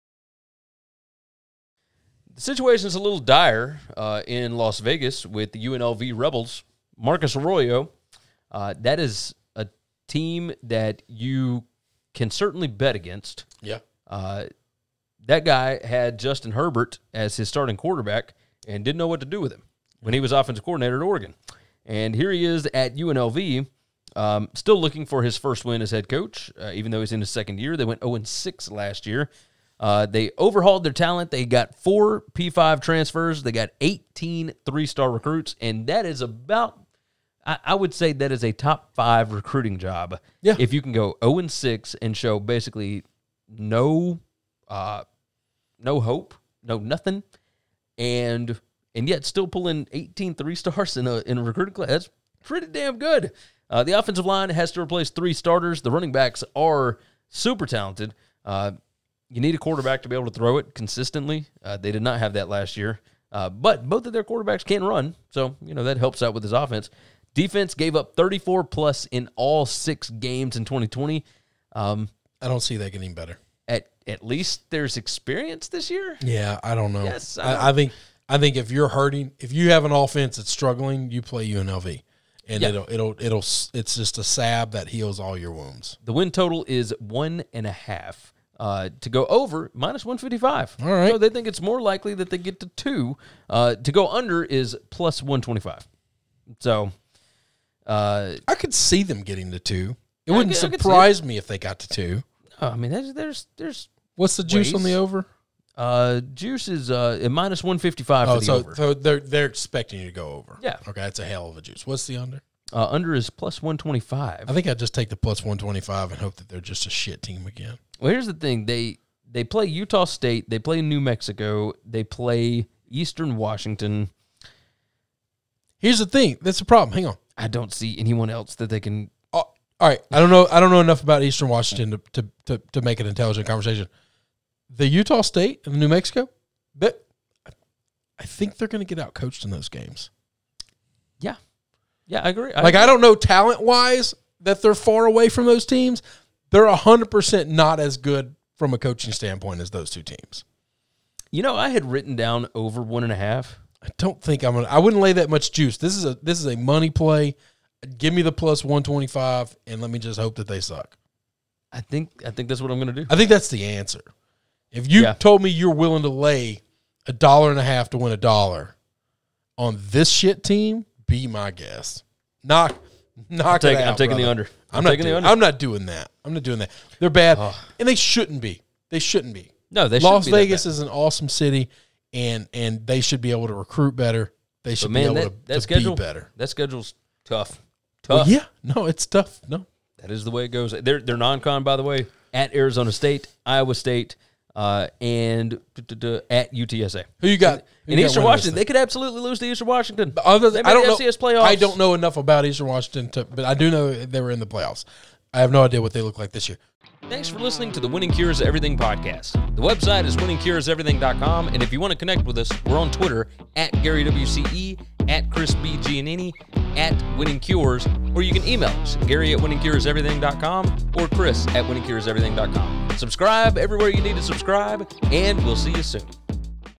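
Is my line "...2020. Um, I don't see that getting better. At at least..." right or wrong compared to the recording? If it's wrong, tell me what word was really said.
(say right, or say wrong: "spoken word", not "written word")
right.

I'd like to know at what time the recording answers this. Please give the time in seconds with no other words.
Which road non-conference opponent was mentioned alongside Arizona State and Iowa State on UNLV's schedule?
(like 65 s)
196 s.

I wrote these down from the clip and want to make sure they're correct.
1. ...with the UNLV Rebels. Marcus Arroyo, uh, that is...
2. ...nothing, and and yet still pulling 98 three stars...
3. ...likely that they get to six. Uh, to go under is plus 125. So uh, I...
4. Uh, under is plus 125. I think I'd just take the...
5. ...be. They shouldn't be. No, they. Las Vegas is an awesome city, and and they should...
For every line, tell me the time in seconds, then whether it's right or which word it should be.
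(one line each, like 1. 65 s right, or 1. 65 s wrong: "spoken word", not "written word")
1. 5 s right
2. 46 s wrong: "18", not "98"
3. 91 s wrong: "two", not "six"
4. 112 s right
5. 178 s right.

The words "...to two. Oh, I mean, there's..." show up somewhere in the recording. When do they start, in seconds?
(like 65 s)
101 s.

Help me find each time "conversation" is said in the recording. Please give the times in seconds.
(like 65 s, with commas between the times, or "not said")
133 s.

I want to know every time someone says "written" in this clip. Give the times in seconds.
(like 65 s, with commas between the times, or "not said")
151 s.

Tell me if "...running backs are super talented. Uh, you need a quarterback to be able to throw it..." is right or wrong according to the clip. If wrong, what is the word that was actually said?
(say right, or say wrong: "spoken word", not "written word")
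right.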